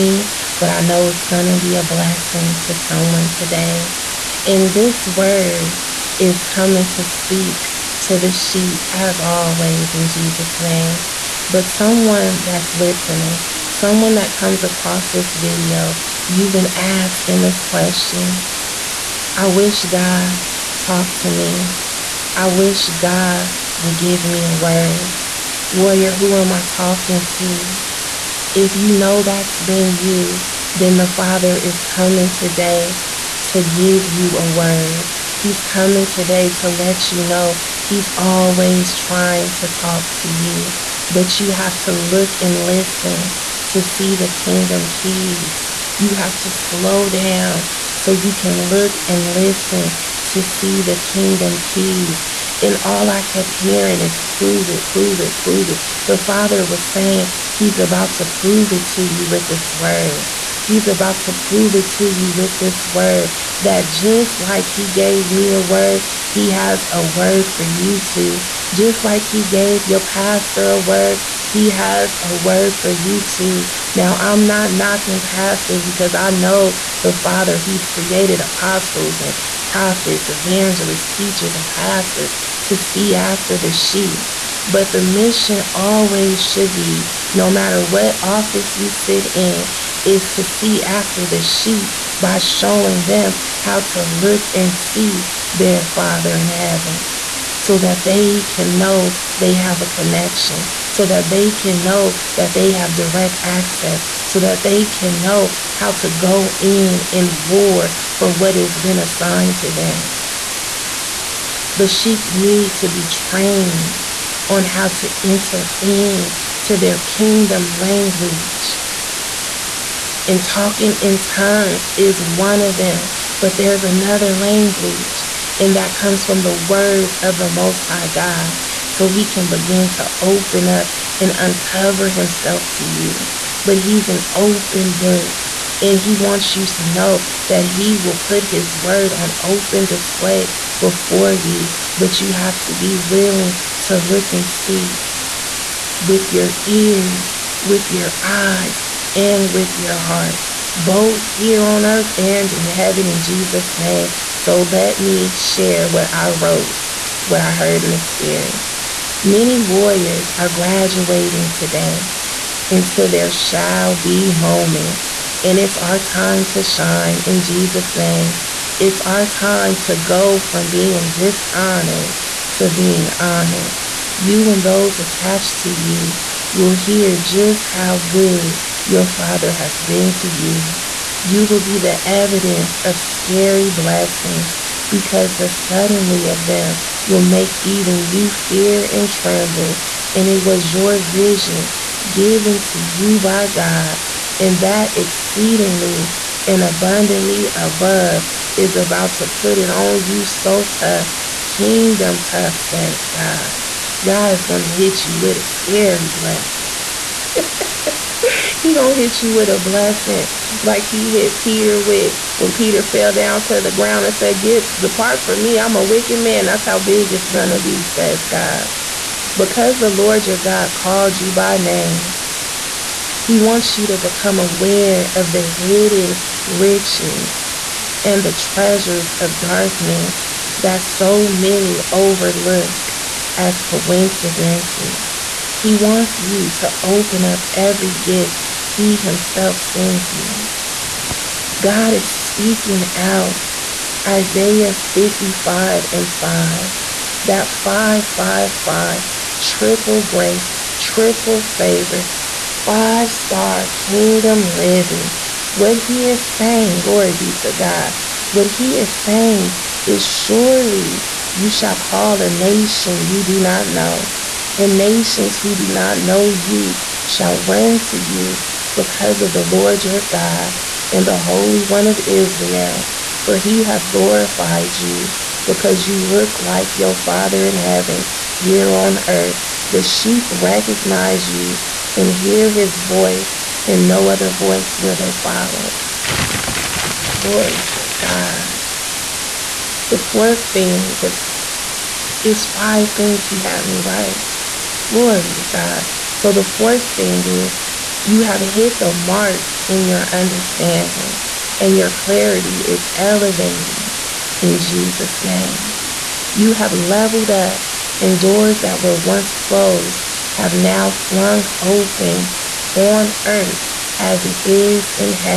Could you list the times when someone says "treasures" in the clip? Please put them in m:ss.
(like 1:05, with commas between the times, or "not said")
3:48.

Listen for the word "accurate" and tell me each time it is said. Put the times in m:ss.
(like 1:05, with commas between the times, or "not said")
not said.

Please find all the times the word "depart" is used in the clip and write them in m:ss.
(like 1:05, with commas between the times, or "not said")
3:34.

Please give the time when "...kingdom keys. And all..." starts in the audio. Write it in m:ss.
0:50.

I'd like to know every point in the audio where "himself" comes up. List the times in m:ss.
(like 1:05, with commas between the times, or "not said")
2:12, 3:58.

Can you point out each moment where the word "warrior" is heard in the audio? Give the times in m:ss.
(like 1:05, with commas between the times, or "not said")
0:25, 2:39.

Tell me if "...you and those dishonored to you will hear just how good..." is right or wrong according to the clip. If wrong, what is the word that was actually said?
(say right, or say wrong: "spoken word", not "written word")
wrong: "attached", not "dishonored".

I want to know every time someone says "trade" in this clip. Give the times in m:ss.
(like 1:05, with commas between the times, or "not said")
not said.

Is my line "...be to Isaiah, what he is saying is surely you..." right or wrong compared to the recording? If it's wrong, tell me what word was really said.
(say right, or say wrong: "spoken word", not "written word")
wrong: "God", not "Isaiah".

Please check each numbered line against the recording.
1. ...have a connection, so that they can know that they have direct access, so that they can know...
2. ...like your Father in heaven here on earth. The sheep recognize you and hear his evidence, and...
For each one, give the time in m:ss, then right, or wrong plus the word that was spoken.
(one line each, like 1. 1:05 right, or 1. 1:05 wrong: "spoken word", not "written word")
1. 1:39 right
2. 4:36 wrong: "voice", not "evidence".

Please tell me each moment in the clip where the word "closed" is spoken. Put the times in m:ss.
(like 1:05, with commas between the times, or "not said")
5:09.